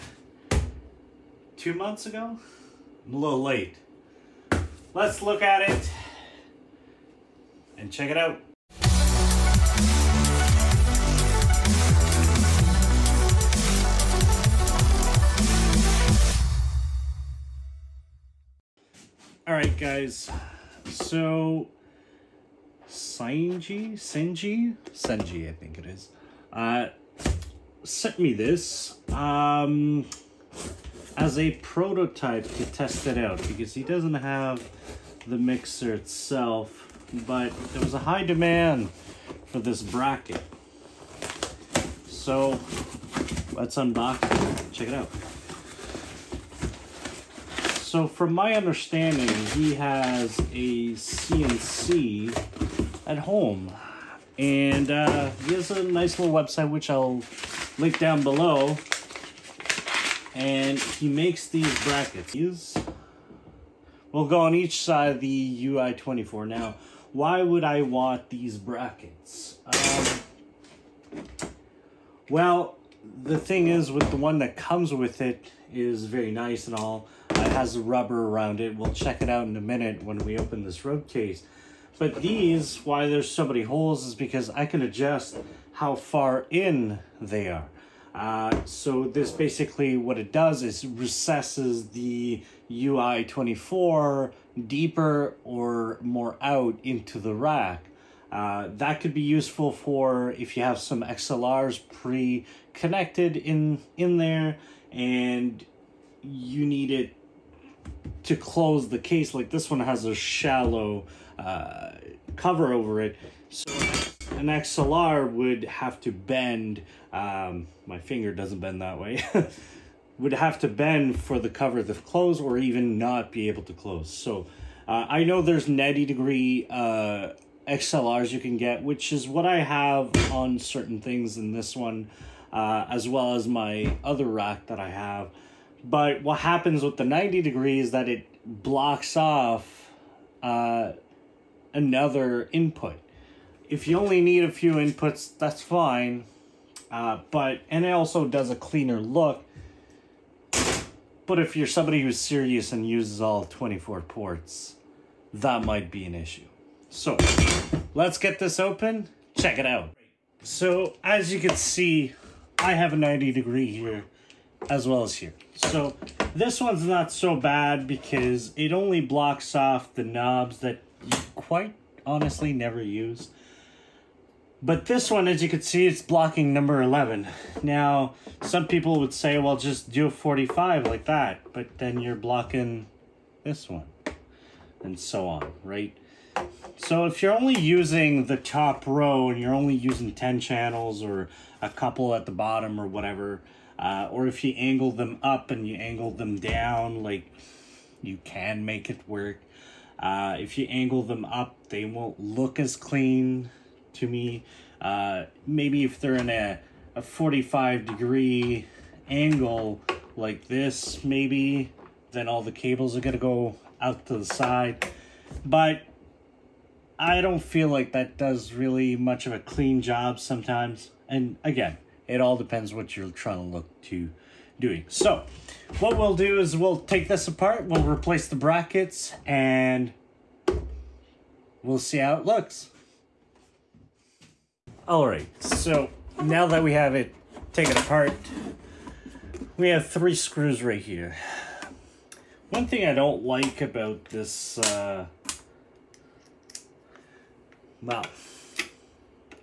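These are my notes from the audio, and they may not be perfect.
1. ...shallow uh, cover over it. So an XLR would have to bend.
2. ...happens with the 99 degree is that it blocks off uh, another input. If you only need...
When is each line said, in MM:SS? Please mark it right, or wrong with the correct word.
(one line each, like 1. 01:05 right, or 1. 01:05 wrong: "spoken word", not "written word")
1. 01:50 right
2. 02:16 wrong: "90", not "99".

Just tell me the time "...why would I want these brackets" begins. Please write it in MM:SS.
01:07.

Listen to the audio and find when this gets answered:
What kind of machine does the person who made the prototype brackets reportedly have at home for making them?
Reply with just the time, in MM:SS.
00:50.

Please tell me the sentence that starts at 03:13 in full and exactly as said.
Uh, or if you angle them up and you angle them down, like you can make it work.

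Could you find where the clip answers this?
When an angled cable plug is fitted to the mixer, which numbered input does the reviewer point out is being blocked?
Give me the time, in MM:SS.
02:56.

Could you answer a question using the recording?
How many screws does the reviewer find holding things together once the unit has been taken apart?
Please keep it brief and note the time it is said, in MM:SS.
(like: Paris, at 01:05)
3, at 03:59.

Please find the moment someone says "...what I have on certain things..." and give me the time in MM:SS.
02:09.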